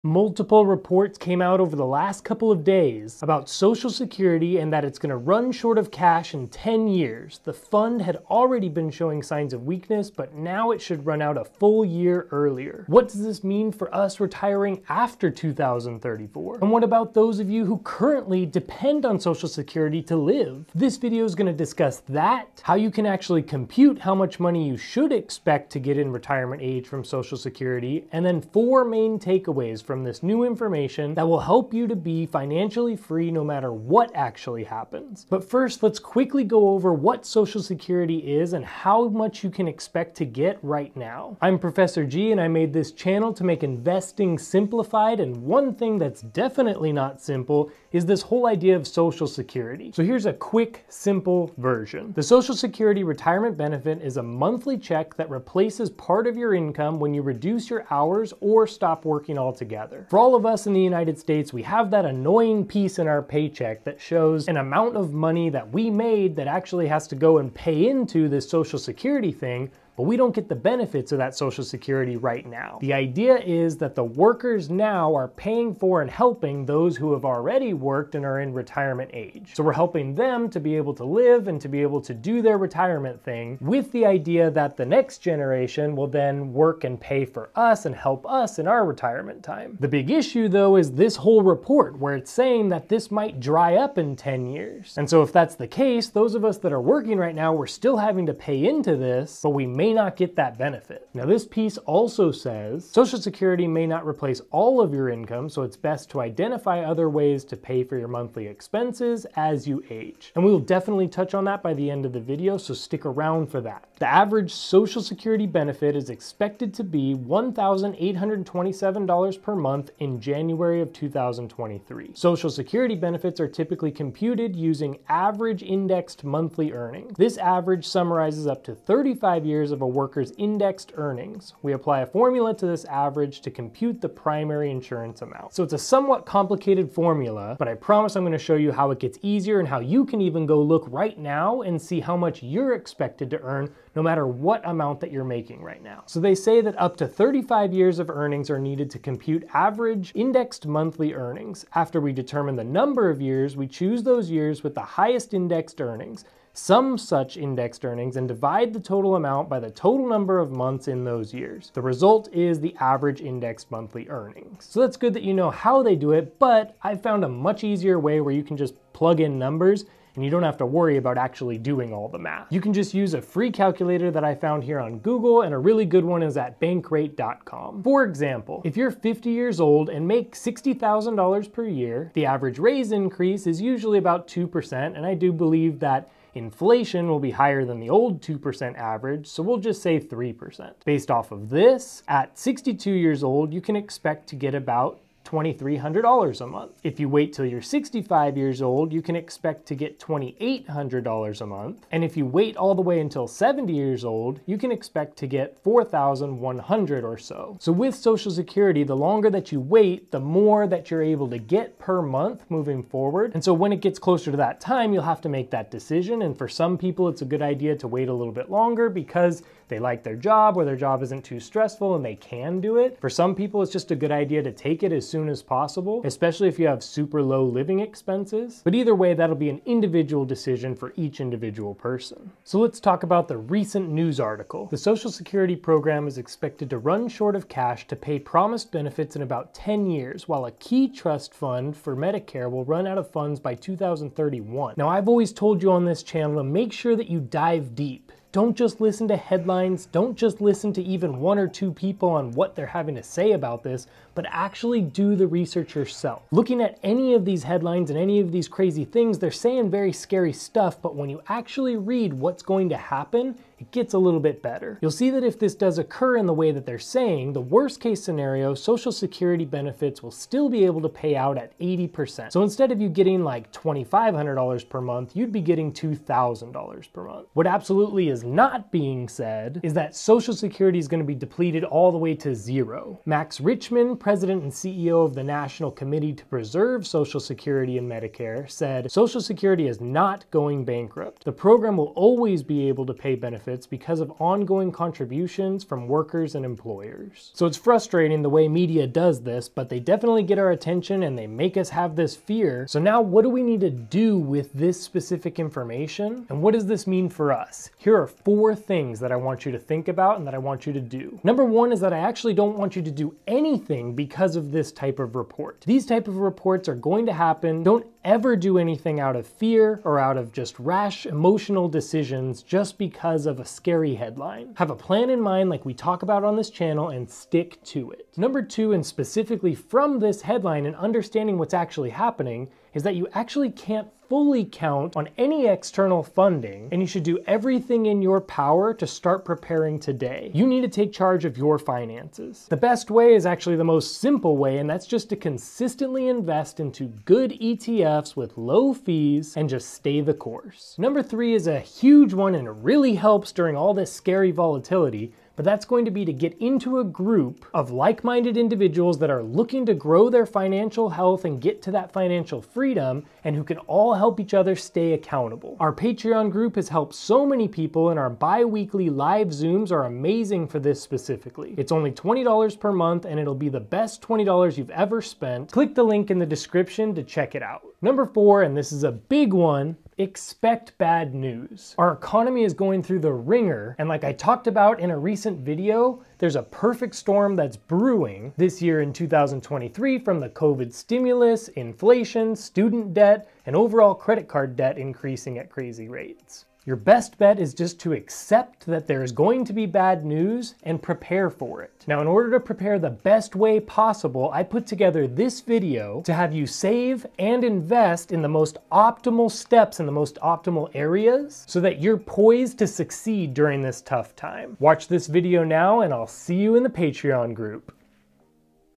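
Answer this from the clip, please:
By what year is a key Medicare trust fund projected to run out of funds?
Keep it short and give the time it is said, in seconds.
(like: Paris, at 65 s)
2031, at 243 s.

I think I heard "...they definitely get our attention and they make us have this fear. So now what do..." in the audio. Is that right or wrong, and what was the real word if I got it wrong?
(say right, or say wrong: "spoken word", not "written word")
right.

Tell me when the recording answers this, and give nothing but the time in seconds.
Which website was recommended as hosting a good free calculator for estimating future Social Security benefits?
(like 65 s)
176 s.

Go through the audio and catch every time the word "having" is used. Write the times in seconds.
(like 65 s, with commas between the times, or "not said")
97 s, 252 s.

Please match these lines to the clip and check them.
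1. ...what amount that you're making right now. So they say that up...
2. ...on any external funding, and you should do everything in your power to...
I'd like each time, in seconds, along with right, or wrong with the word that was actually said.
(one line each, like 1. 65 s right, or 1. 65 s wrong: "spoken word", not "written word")
1. 144 s right
2. 334 s right.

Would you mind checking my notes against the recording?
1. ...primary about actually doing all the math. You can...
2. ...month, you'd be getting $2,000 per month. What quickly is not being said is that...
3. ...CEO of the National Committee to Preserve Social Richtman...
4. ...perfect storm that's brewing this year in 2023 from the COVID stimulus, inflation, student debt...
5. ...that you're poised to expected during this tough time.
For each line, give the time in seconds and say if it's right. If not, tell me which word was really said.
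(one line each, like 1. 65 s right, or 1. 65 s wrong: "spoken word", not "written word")
1. 170 s wrong: "worry", not "primary"
2. 274 s wrong: "absolutely", not "quickly"
3. 284 s wrong: "Security", not "Richtman"
4. 386 s right
5. 411 s wrong: "succeed", not "expected".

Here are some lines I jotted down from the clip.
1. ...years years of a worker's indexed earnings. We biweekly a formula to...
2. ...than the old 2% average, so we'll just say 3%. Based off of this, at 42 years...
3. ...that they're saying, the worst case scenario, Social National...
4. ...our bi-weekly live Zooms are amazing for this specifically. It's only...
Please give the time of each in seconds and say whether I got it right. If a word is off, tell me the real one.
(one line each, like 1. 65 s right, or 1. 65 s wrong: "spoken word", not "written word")
1. 129 s wrong: "apply", not "biweekly"
2. 187 s wrong: "62", not "42"
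3. 266 s wrong: "Security", not "National"
4. 367 s right.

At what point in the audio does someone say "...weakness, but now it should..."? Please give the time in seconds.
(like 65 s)
9 s.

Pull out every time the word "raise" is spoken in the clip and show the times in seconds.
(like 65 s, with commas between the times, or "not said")
182 s.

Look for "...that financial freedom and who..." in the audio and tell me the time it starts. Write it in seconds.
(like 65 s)
361 s.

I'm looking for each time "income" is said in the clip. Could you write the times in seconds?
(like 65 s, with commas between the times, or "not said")
56 s, 105 s.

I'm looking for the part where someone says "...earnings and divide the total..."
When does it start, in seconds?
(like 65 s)
157 s.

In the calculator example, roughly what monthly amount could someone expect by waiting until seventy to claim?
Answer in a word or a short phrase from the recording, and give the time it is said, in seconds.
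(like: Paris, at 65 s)
$4,100, at 205 s.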